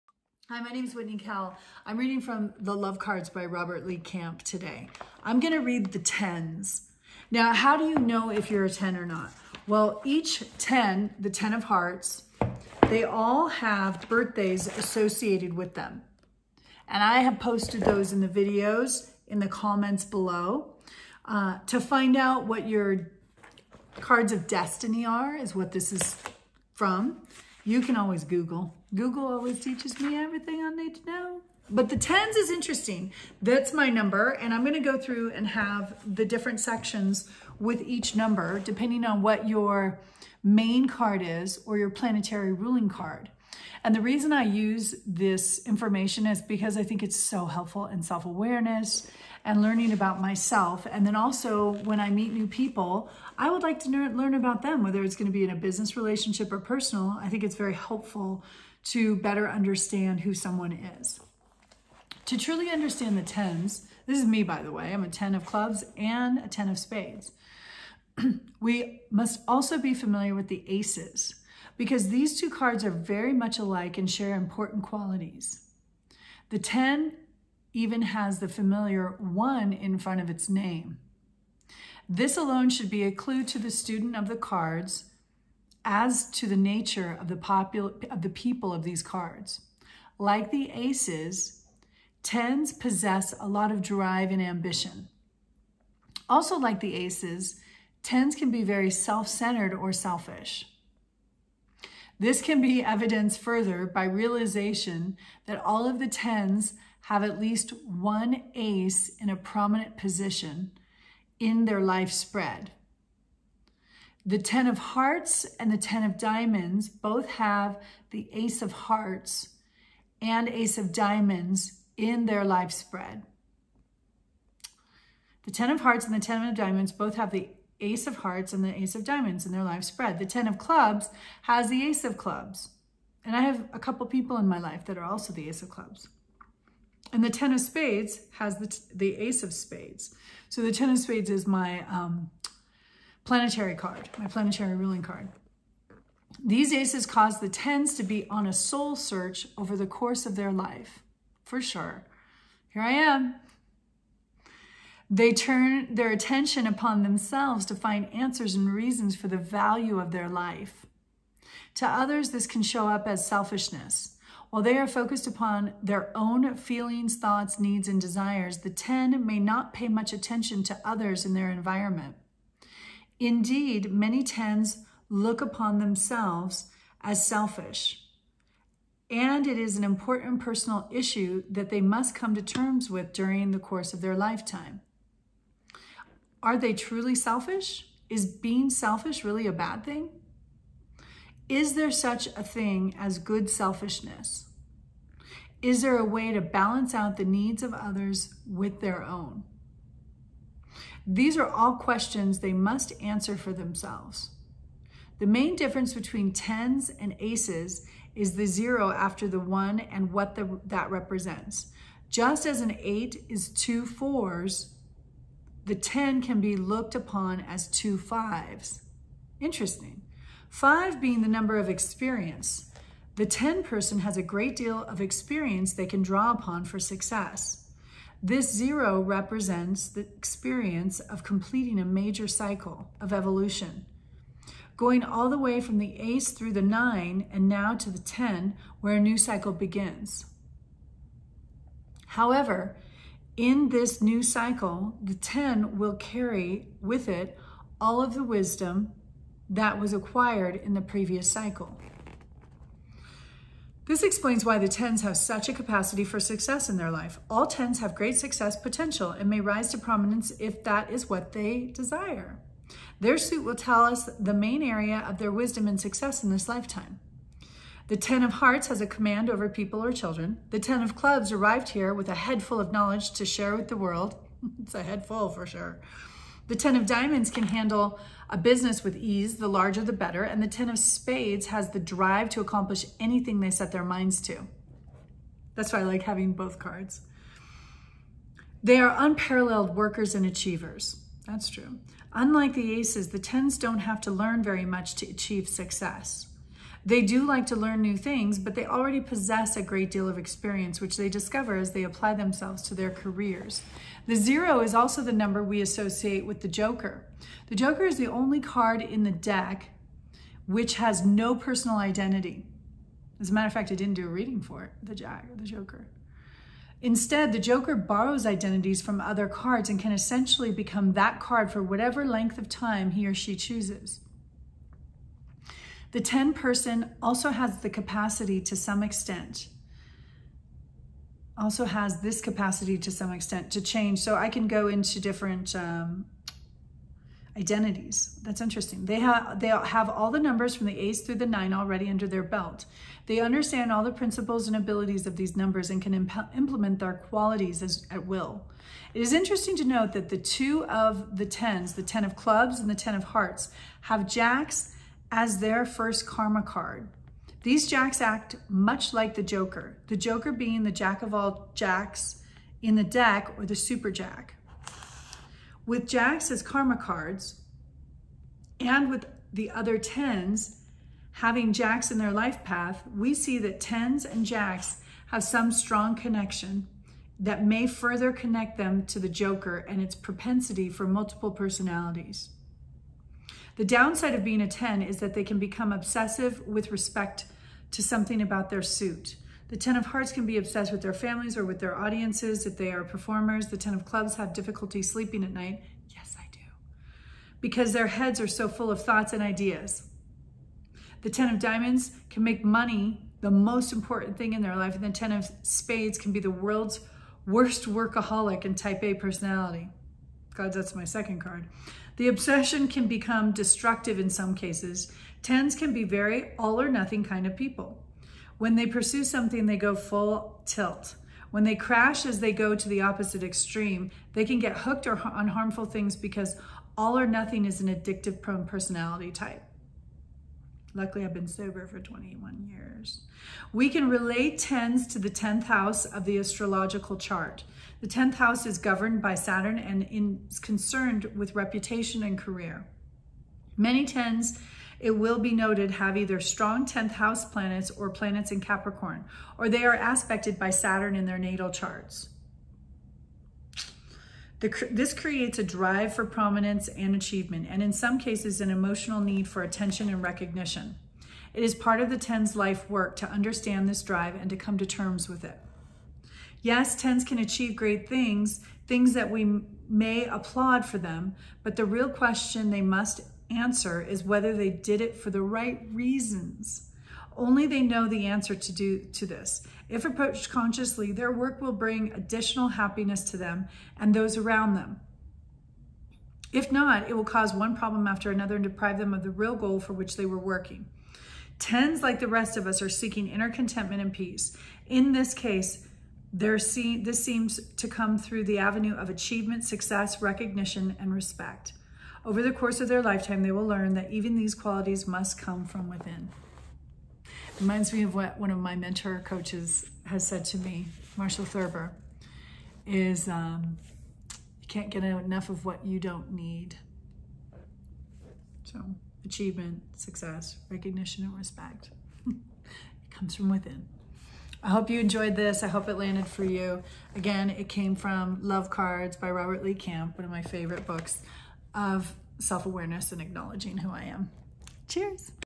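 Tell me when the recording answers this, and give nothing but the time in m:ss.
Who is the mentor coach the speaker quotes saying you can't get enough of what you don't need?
8:30.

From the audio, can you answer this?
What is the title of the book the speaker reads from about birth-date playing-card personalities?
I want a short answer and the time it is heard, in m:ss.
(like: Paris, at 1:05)
The Love Cards, at 0:02.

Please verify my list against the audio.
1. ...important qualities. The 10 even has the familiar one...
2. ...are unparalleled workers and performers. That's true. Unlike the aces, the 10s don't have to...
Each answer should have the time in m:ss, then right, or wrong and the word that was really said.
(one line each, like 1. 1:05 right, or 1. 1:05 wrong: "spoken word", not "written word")
1. 1:14 right
2. 4:48 wrong: "achievers", not "performers".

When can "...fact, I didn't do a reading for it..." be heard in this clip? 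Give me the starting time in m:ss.
5:13.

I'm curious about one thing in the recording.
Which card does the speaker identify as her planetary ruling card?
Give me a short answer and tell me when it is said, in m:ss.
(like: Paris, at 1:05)
10 of spades, at 2:20.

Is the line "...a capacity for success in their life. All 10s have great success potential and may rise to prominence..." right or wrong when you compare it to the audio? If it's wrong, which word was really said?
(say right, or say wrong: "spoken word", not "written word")
right.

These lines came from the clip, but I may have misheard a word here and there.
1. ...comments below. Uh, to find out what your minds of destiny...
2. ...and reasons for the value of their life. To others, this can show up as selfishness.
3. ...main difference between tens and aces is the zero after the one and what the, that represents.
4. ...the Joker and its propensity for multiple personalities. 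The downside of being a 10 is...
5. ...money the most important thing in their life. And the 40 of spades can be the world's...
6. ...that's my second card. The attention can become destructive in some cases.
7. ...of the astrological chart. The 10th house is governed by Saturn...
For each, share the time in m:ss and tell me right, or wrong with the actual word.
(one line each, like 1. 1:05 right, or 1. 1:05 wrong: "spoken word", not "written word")
1. 0:19 wrong: "cards", not "minds"
2. 2:38 right
3. 3:25 right
4. 6:18 right
5. 6:42 wrong: "10", not "40"
6. 6:50 wrong: "obsession", not "attention"
7. 7:15 right.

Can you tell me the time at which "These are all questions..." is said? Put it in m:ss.
3:21.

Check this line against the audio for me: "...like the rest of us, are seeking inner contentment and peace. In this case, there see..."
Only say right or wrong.
right.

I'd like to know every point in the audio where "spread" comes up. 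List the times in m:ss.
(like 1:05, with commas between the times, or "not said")
1:52, 2:02, 2:09.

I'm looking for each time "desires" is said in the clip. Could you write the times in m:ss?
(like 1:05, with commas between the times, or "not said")
2:47, 4:21.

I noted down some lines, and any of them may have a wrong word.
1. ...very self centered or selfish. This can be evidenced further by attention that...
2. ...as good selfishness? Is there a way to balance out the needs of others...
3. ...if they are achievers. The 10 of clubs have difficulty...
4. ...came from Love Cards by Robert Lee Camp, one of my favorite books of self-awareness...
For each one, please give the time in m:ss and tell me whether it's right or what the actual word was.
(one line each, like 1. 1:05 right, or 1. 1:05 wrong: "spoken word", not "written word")
1. 1:38 wrong: "realization", not "attention"
2. 3:12 right
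3. 6:32 wrong: "performers", not "achievers"
4. 8:47 right.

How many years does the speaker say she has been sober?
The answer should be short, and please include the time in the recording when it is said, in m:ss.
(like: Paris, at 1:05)
21, at 7:11.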